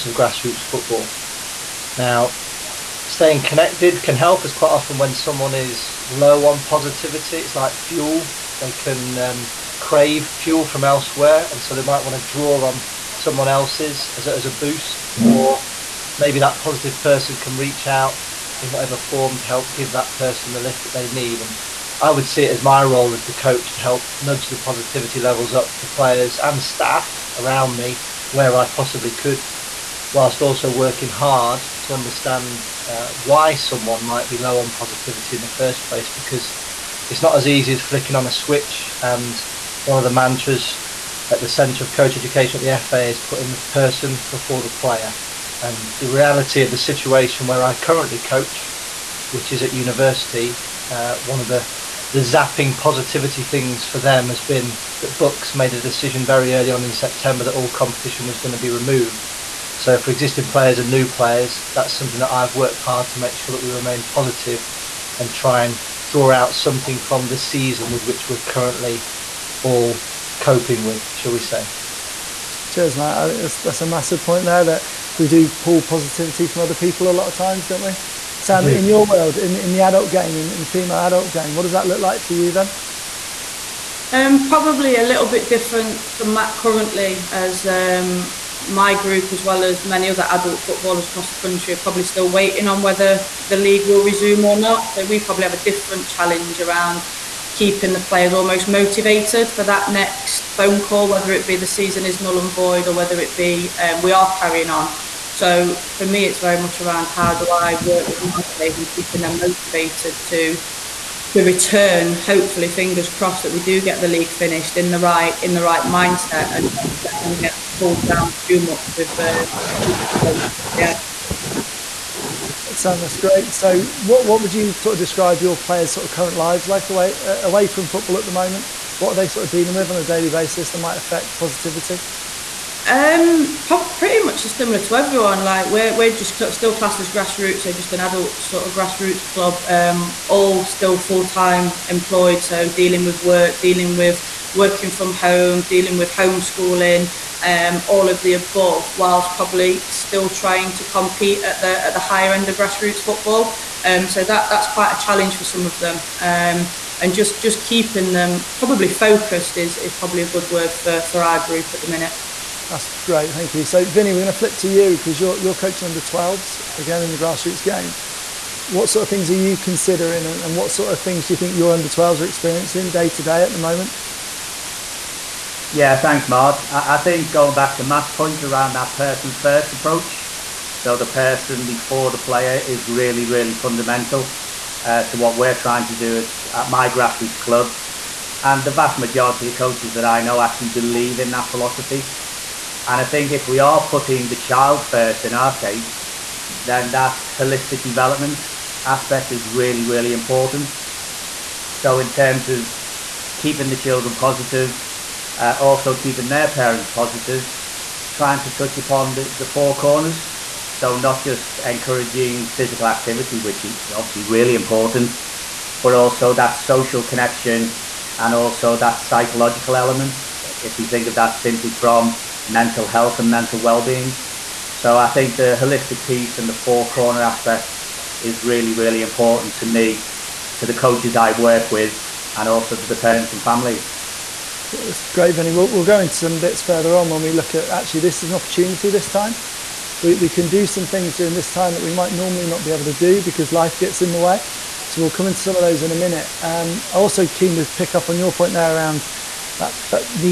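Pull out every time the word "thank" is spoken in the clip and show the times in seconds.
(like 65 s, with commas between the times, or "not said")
163 s, 175 s.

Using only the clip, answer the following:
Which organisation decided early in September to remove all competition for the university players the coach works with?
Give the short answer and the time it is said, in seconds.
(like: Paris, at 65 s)
BUCS, at 55 s.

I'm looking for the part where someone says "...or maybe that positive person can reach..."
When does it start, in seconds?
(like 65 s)
15 s.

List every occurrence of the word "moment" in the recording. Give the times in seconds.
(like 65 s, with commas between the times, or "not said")
128 s, 173 s.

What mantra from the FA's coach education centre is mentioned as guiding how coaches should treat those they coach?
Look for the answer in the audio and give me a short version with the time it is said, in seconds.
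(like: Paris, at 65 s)
Putting the person before the player, at 43 s.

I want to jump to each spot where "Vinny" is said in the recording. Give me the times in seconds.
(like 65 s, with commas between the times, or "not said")
163 s, 235 s.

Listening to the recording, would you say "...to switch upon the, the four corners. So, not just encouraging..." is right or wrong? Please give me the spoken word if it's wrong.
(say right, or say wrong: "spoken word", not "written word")
wrong: "touch", not "switch".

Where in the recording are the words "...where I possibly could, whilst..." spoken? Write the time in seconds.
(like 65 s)
28 s.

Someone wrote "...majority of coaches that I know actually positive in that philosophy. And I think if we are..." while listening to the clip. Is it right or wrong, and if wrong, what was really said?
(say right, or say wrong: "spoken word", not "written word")
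wrong: "believe", not "positive".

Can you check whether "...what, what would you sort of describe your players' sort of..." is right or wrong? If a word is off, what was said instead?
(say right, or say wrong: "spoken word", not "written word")
right.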